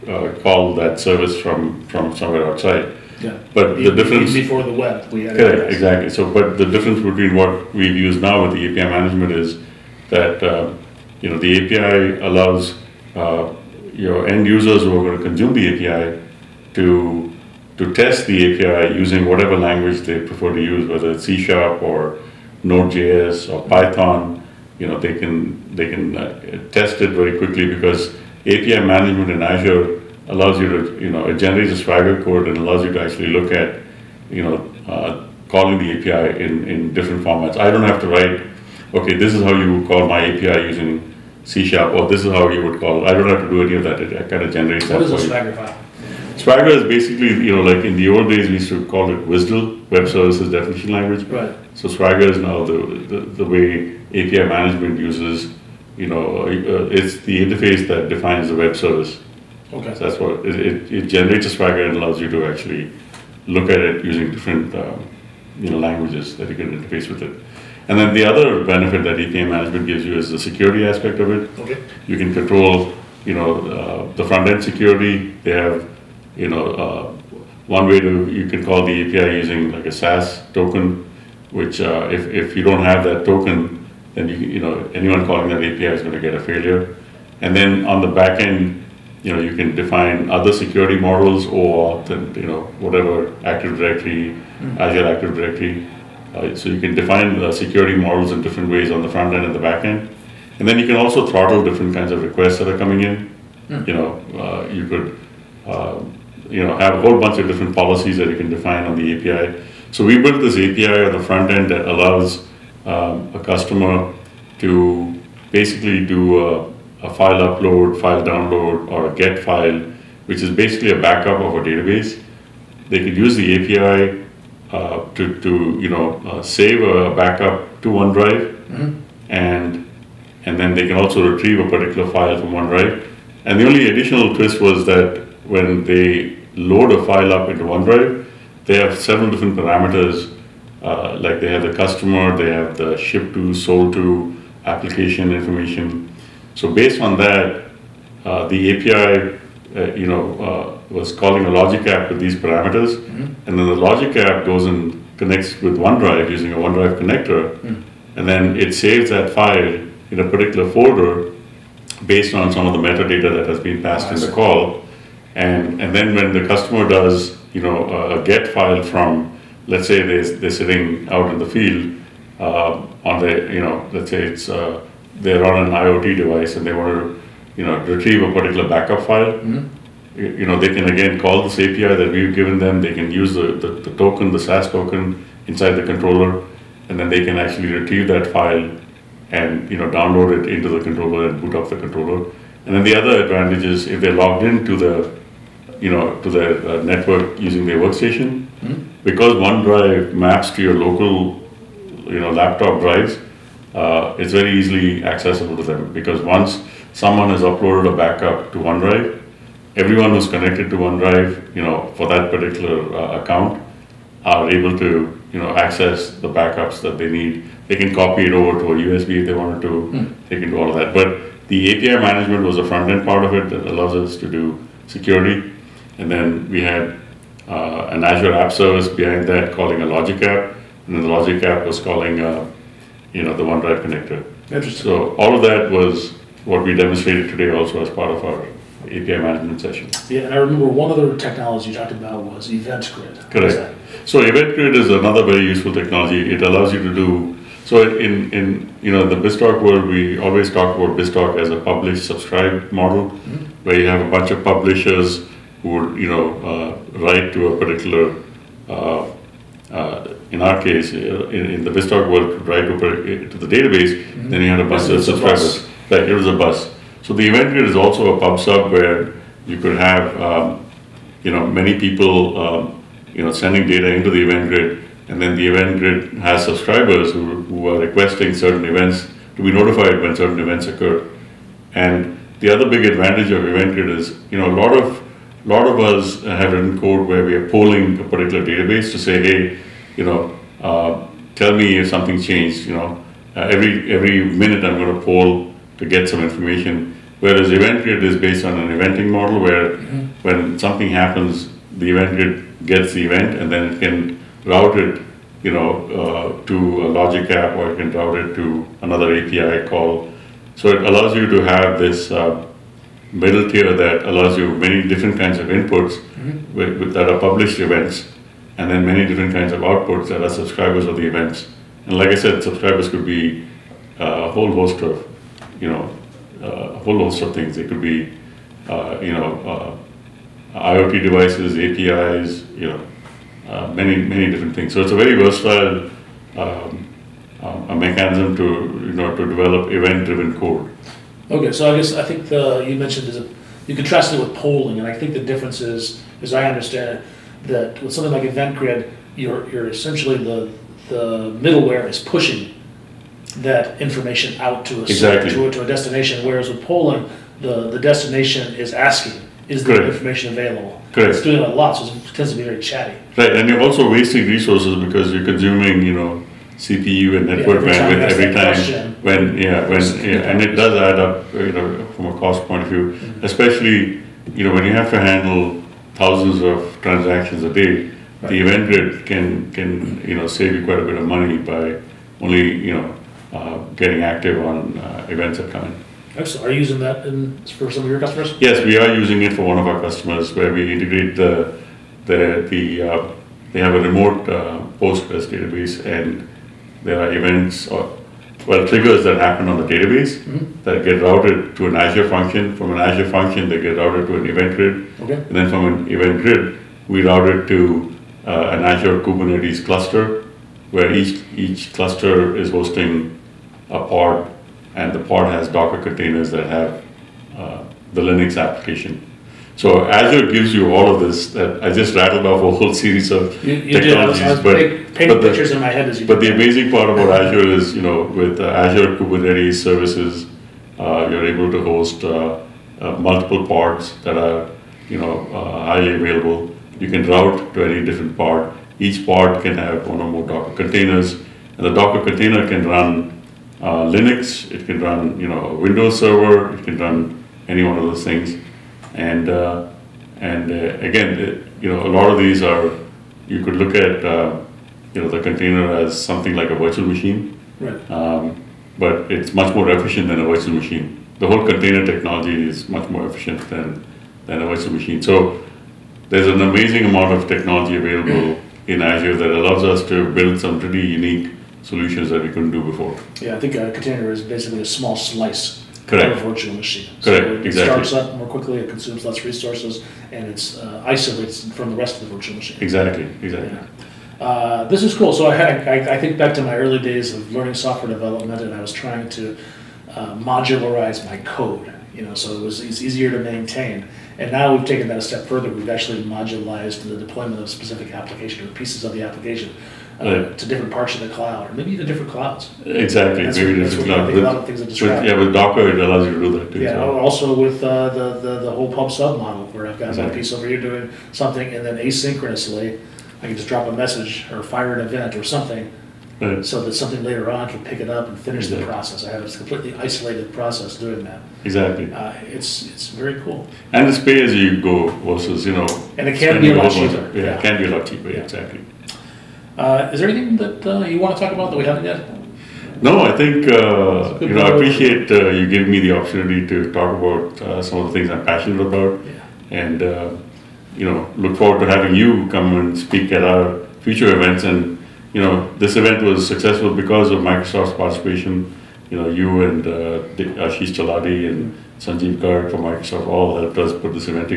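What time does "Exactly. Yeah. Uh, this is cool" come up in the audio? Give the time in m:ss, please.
8:03.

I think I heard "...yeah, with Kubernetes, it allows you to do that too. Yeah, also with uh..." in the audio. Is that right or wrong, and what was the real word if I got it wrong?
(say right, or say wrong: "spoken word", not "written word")
wrong: "Docker", not "Kubernetes".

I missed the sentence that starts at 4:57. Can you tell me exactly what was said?
Whereas event grid is based on an eventing model where mm-hmm.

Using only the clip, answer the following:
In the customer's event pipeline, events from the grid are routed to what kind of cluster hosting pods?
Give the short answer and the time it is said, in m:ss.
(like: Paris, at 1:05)
Azure Kubernetes cluster, at 6:48.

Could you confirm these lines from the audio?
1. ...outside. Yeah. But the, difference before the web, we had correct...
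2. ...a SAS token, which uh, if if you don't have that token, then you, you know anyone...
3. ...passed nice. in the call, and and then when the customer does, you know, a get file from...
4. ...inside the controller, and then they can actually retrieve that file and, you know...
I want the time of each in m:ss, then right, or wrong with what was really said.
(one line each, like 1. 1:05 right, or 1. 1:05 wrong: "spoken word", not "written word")
1. 0:02 right
2. 1:19 right
3. 2:43 right
4. 3:05 right.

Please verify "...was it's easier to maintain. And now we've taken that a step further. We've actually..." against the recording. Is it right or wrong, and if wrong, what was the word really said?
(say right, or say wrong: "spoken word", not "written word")
right.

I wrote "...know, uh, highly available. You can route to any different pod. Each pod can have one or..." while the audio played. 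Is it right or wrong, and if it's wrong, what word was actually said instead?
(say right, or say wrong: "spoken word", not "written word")
right.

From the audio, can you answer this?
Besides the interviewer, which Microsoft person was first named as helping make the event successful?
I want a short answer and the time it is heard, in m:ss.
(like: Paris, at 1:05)
Ashish Chaladi, at 9:10.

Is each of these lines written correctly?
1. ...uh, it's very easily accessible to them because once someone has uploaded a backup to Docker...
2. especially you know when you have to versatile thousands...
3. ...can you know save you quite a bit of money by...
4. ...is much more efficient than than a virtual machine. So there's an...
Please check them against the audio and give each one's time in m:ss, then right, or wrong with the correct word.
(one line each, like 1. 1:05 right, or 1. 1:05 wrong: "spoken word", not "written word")
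1. 3:23 wrong: "OneDrive", not "Docker"
2. 6:13 wrong: "handle", not "versatile"
3. 6:19 right
4. 7:42 right.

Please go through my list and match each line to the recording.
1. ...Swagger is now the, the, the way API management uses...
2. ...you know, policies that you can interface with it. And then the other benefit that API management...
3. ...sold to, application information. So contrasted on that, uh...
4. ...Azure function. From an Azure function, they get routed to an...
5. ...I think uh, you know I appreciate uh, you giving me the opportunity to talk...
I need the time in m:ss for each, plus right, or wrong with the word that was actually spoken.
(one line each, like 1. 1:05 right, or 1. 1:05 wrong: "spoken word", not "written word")
1. 0:51 right
2. 1:05 wrong: "languages", not "policies"
3. 2:23 wrong: "based", not "contrasted"
4. 6:41 right
5. 8:53 right.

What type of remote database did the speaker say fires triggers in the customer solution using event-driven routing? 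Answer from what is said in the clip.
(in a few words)
Postgres.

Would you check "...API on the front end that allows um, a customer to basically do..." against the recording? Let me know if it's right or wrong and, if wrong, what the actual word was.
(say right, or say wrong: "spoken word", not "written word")
right.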